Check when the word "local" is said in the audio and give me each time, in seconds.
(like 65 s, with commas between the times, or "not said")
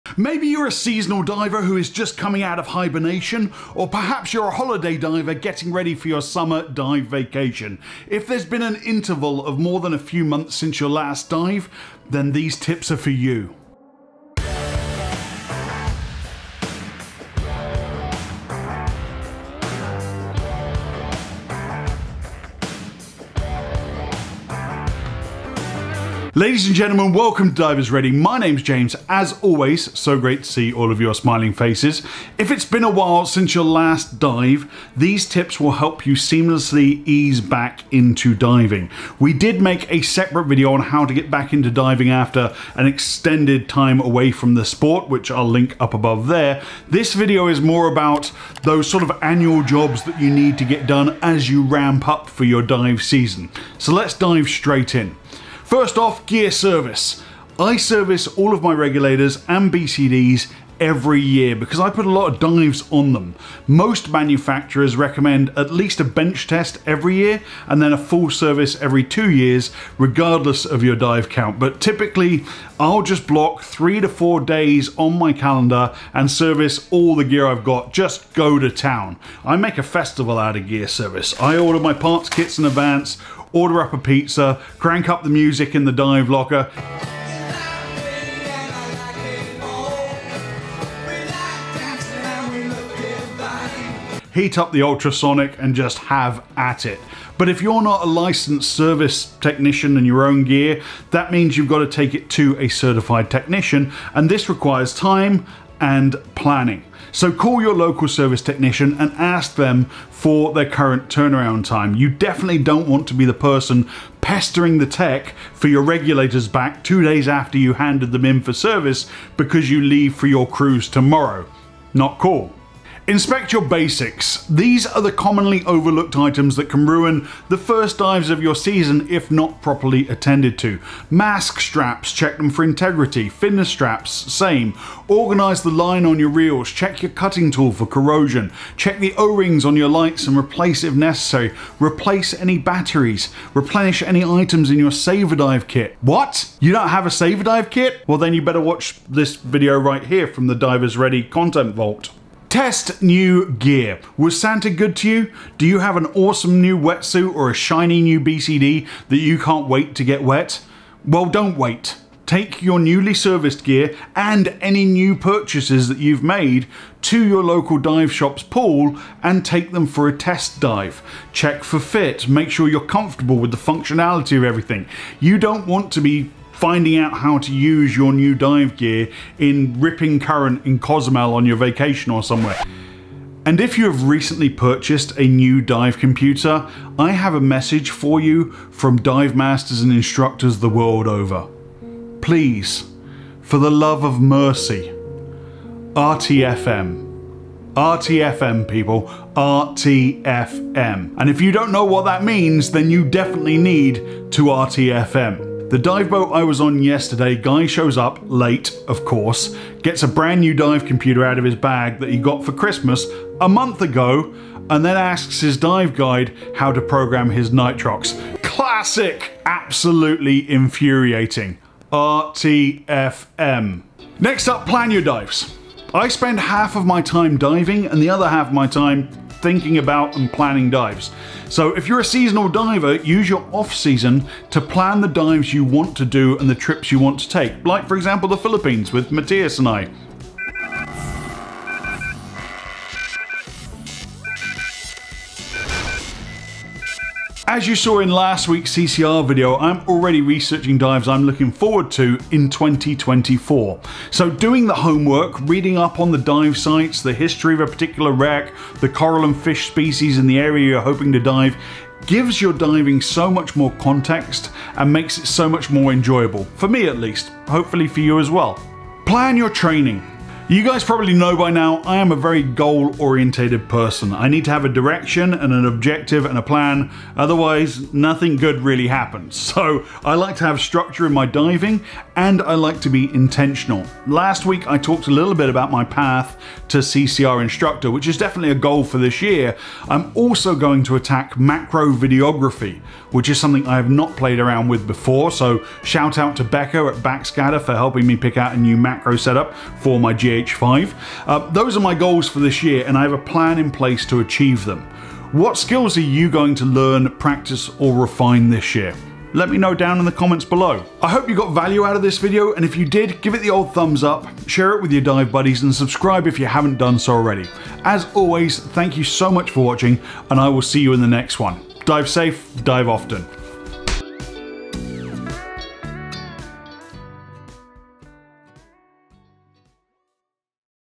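107 s, 167 s.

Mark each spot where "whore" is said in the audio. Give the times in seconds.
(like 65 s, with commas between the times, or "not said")
not said.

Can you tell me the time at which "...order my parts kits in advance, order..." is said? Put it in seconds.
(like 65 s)
81 s.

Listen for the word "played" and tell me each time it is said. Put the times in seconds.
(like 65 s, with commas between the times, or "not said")
294 s.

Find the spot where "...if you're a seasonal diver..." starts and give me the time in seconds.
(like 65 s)
231 s.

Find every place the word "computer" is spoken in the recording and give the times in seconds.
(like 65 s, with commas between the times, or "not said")
185 s, 210 s.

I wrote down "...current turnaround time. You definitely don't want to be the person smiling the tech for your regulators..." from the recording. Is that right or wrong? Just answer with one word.
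wrong.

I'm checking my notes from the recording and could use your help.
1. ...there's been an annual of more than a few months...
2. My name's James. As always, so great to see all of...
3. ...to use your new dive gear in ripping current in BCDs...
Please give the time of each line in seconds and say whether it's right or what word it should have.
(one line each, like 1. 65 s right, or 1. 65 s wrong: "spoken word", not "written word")
1. 8 s wrong: "interval", not "annual"
2. 28 s right
3. 177 s wrong: "Cozumel", not "BCDs".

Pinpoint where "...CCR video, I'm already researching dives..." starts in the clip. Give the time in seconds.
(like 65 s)
248 s.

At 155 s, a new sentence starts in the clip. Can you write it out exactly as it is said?
Do you have an awesome new wetsuit or a shiny new BCD that you can't wait to get wet?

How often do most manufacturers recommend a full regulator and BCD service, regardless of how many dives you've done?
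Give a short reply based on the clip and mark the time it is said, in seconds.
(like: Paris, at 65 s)
every 2 years, at 68 s.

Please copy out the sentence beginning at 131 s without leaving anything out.
Mask straps, check them for integrity.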